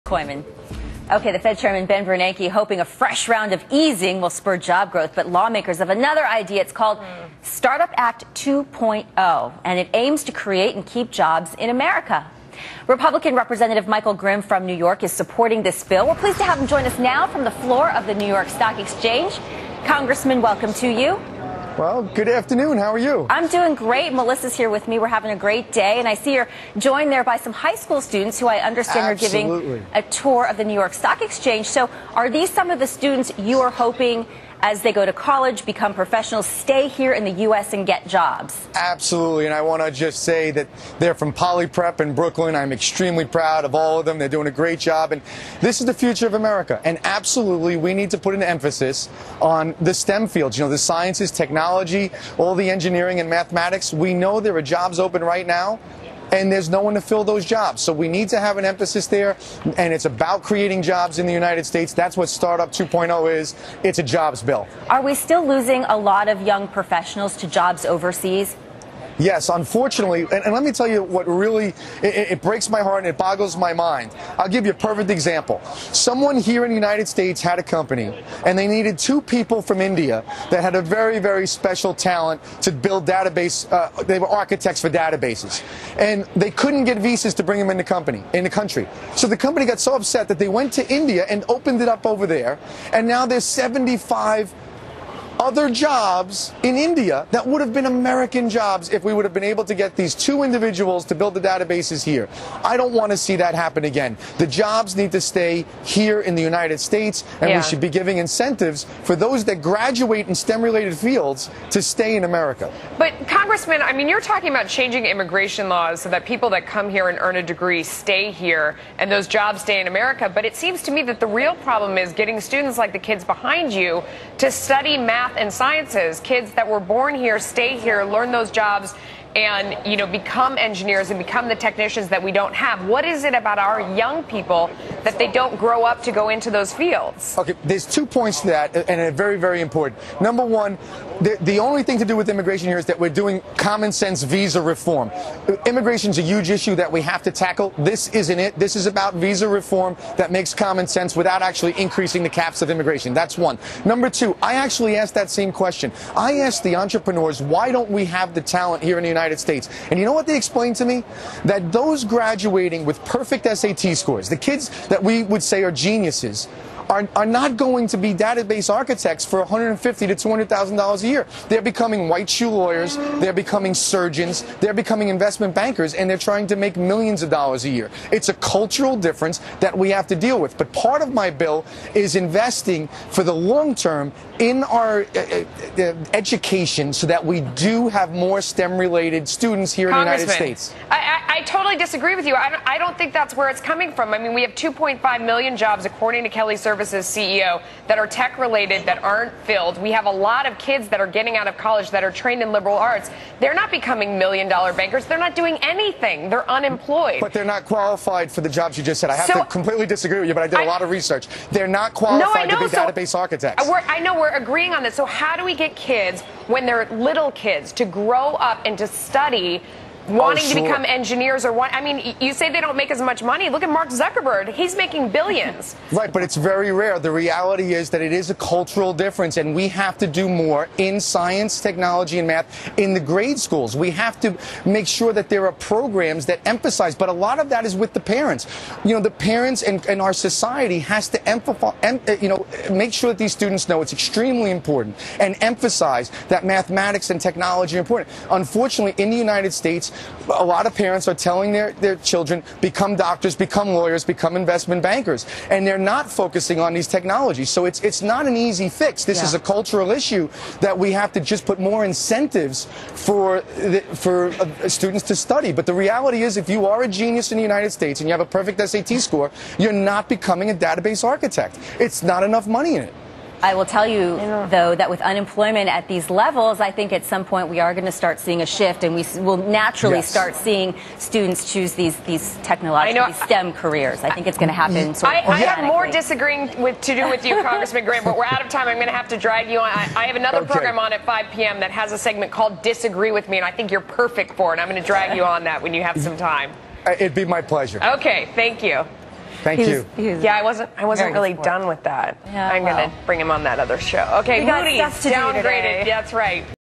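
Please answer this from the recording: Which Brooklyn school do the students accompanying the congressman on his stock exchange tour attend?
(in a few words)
Poly Prep.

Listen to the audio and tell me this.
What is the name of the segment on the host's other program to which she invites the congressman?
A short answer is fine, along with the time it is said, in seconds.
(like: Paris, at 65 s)
Disagree with Me, at 292 s.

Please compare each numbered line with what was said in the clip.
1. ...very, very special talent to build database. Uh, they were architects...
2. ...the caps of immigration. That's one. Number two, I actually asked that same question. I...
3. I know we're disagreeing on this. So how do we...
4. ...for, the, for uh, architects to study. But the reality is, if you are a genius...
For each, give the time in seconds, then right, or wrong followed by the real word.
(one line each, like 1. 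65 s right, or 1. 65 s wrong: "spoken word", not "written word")
1. 80 s right
2. 152 s right
3. 213 s wrong: "agreeing", not "disagreeing"
4. 262 s wrong: "students", not "architects".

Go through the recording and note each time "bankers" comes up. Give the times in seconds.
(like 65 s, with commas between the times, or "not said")
175 s, 204 s, 254 s.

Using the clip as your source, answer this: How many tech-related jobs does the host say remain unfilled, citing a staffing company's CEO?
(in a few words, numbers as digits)
2.5 million.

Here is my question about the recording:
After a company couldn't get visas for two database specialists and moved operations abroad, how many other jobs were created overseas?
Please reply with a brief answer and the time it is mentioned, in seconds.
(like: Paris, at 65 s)
75, at 93 s.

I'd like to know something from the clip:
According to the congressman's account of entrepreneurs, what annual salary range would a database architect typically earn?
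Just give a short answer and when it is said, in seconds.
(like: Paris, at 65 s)
150 to 200 thousand dollars, at 169 s.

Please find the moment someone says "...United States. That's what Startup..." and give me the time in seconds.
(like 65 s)
61 s.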